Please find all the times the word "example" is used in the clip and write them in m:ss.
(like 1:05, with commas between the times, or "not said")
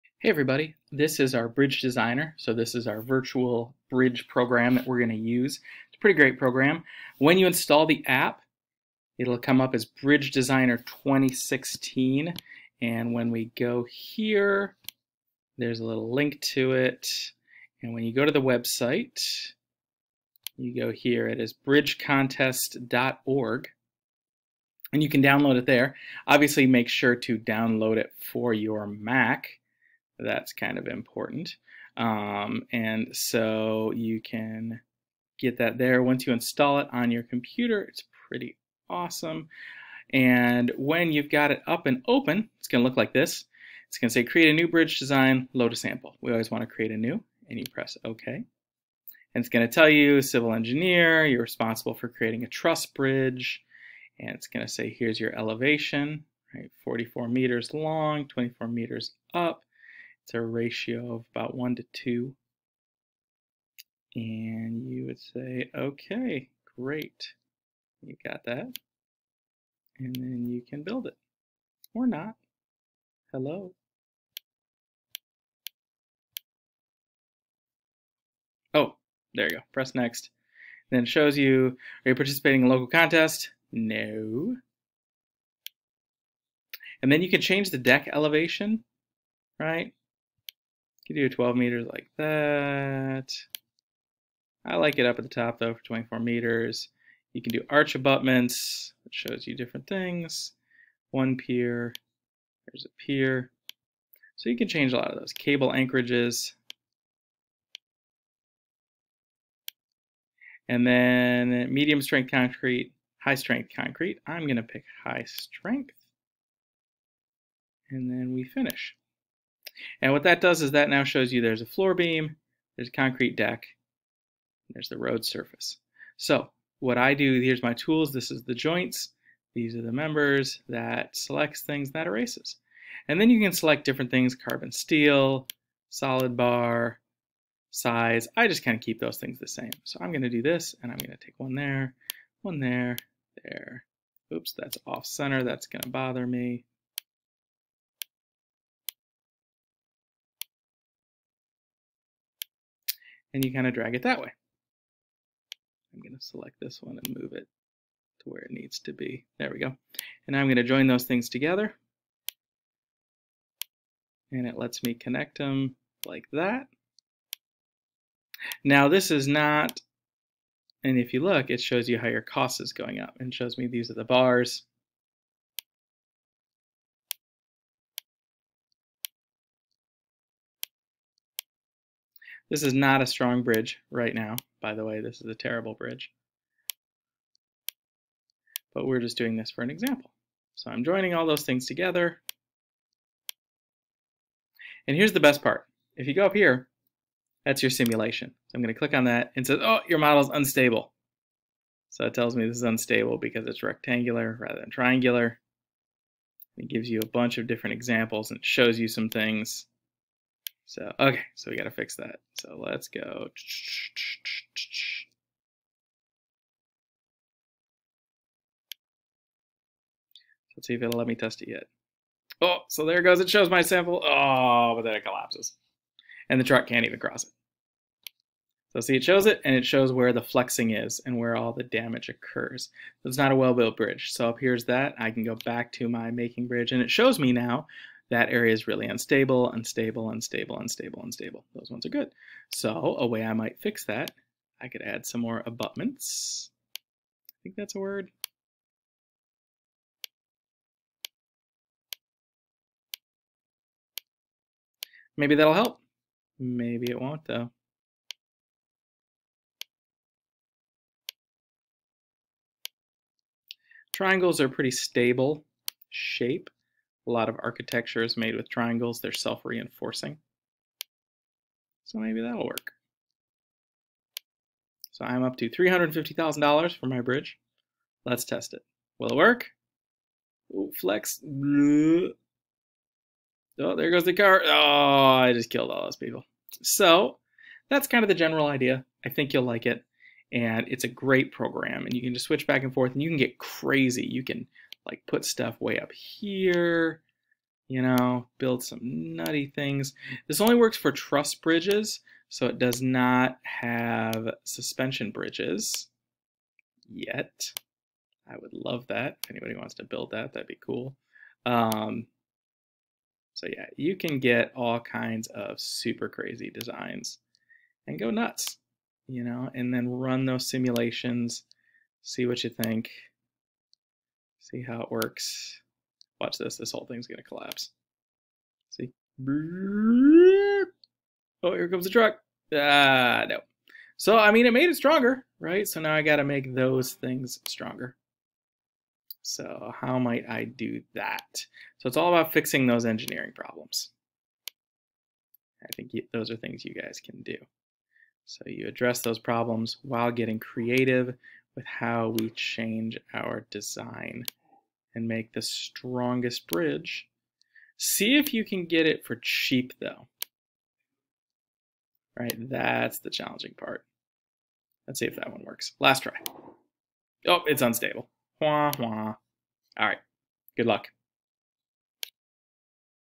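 3:09, 3:27.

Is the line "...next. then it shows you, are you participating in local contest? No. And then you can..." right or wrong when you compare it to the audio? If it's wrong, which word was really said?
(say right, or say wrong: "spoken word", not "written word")
right.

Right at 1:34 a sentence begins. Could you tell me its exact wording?
I like it up at the top though for 24 meters.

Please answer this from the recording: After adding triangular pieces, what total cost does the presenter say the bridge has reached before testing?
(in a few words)
$350,000.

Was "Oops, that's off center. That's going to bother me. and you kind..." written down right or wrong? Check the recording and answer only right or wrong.
right.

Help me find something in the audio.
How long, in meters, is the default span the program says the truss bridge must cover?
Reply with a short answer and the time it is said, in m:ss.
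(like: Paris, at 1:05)
44 meters, at 0:56.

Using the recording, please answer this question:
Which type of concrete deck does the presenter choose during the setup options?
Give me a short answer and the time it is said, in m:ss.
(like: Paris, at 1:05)
high strength concrete, at 1:53.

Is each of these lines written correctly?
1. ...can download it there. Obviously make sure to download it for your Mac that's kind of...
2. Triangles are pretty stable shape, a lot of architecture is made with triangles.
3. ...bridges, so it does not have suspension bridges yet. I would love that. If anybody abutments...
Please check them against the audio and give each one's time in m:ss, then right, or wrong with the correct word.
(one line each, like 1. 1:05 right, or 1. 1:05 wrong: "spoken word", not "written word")
1. 0:25 right
2. 4:23 right
3. 5:01 wrong: "wants", not "abutments".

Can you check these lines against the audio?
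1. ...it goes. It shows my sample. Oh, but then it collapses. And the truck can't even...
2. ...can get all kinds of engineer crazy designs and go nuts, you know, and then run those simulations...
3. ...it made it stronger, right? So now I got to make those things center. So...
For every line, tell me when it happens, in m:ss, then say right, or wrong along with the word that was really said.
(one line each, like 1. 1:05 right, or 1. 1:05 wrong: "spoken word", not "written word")
1. 3:42 right
2. 5:13 wrong: "super", not "engineer"
3. 5:34 wrong: "stronger", not "center".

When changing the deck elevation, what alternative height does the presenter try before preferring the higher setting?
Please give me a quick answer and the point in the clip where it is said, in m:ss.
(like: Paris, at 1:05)
12 meters, at 1:31.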